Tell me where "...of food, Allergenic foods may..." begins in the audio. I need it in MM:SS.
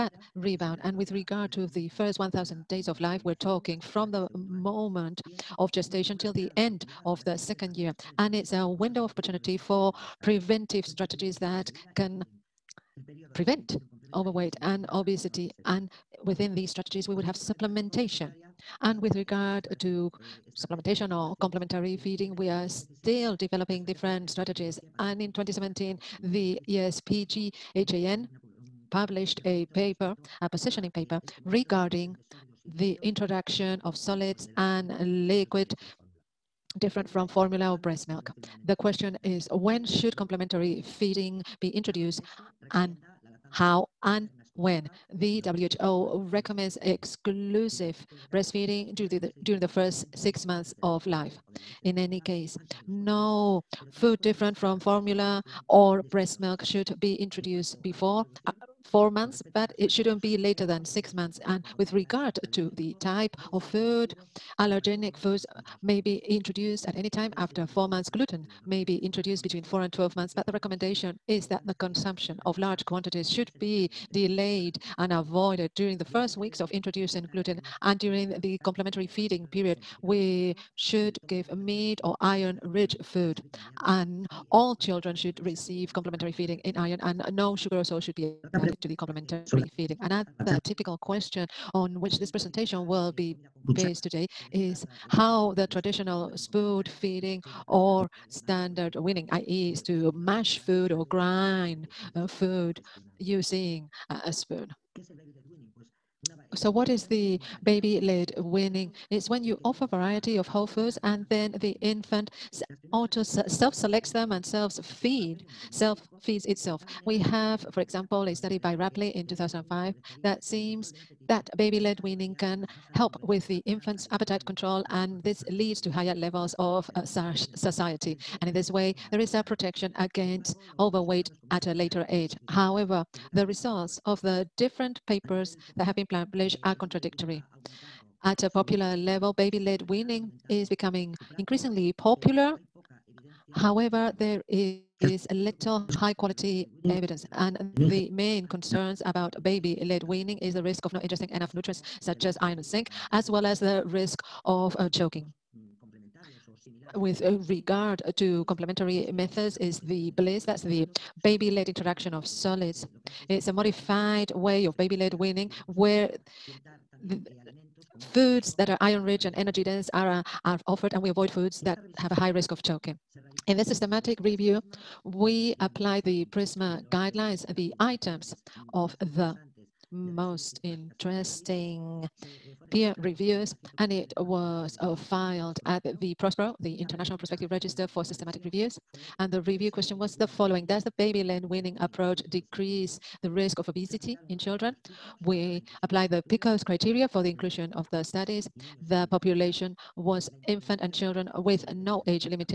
01:03.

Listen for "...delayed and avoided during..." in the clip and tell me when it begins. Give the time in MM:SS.
01:14.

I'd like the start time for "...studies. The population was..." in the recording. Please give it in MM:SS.
03:18.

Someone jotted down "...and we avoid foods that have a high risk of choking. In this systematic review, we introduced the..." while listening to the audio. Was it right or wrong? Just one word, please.
wrong.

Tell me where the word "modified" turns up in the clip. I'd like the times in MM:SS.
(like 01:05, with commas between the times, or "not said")
02:43.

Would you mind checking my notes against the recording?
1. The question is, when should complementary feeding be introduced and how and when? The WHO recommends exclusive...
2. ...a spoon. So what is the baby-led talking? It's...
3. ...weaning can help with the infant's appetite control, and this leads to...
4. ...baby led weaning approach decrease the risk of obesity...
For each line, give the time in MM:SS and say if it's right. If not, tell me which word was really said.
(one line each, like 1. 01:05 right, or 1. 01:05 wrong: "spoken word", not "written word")
1. 00:38 right
2. 01:44 wrong: "weaning", not "talking"
3. 02:02 right
4. 03:10 right.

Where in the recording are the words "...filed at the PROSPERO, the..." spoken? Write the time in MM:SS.
03:04.